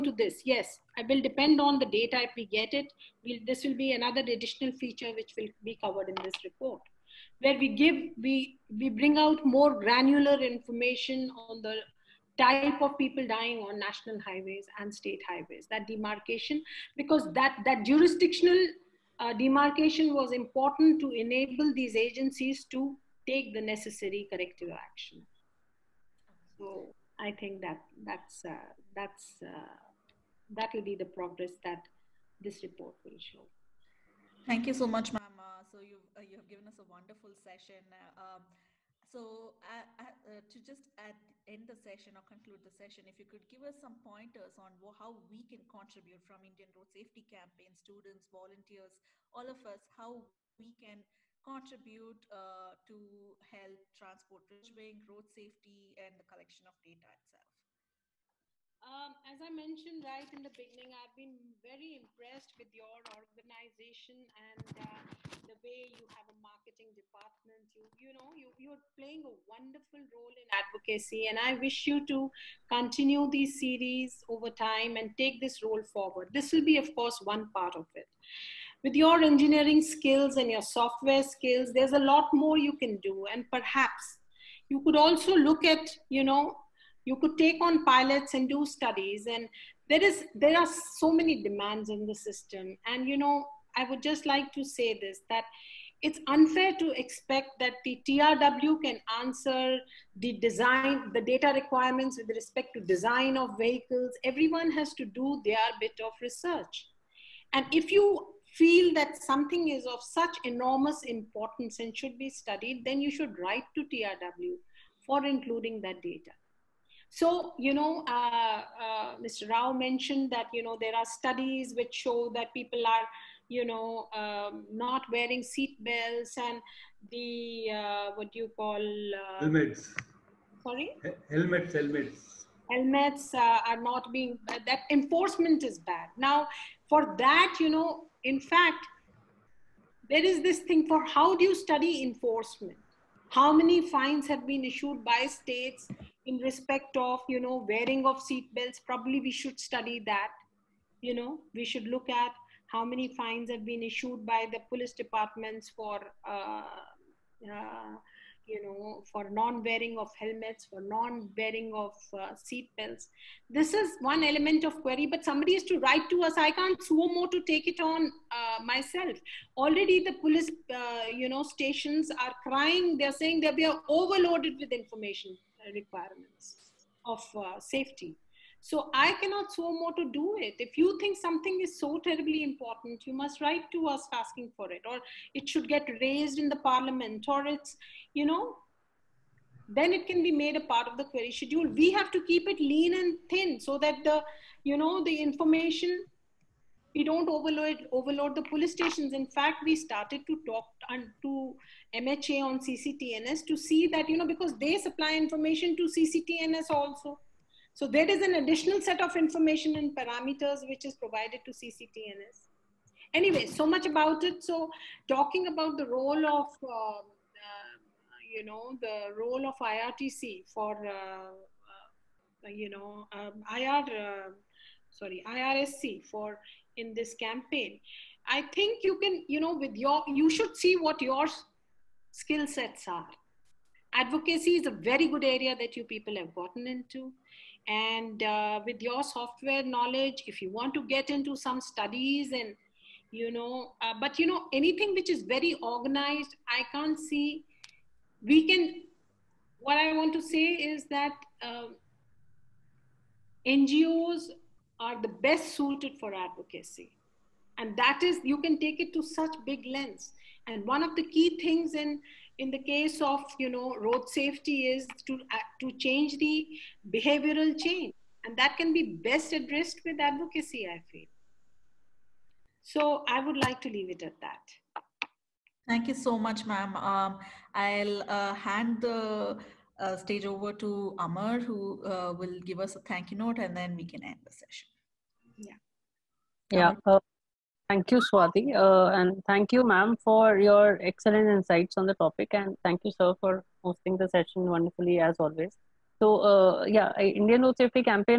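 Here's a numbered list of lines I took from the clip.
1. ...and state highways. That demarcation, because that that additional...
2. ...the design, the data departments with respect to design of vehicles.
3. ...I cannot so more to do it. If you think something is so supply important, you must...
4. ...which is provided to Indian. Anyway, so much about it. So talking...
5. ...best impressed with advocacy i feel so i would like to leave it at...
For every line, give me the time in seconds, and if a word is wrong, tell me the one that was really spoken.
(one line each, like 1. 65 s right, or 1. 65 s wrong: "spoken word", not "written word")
1. 14 s wrong: "jurisdictional", not "additional"
2. 100 s wrong: "requirements", not "departments"
3. 178 s wrong: "terribly", not "supply"
4. 210 s wrong: "CCTNS", not "Indian"
5. 269 s wrong: "addressed", not "impressed".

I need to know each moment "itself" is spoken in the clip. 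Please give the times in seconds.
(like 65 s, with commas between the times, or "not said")
57 s.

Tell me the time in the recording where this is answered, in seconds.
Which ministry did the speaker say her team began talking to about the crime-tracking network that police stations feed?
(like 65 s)
201 s.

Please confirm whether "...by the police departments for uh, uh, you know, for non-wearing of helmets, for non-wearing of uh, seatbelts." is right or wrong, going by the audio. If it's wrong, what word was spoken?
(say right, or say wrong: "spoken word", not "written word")
right.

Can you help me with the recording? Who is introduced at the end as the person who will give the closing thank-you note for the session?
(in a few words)
Amar.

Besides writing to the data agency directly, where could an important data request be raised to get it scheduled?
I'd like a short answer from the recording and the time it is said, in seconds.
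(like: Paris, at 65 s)
the parliament, at 186 s.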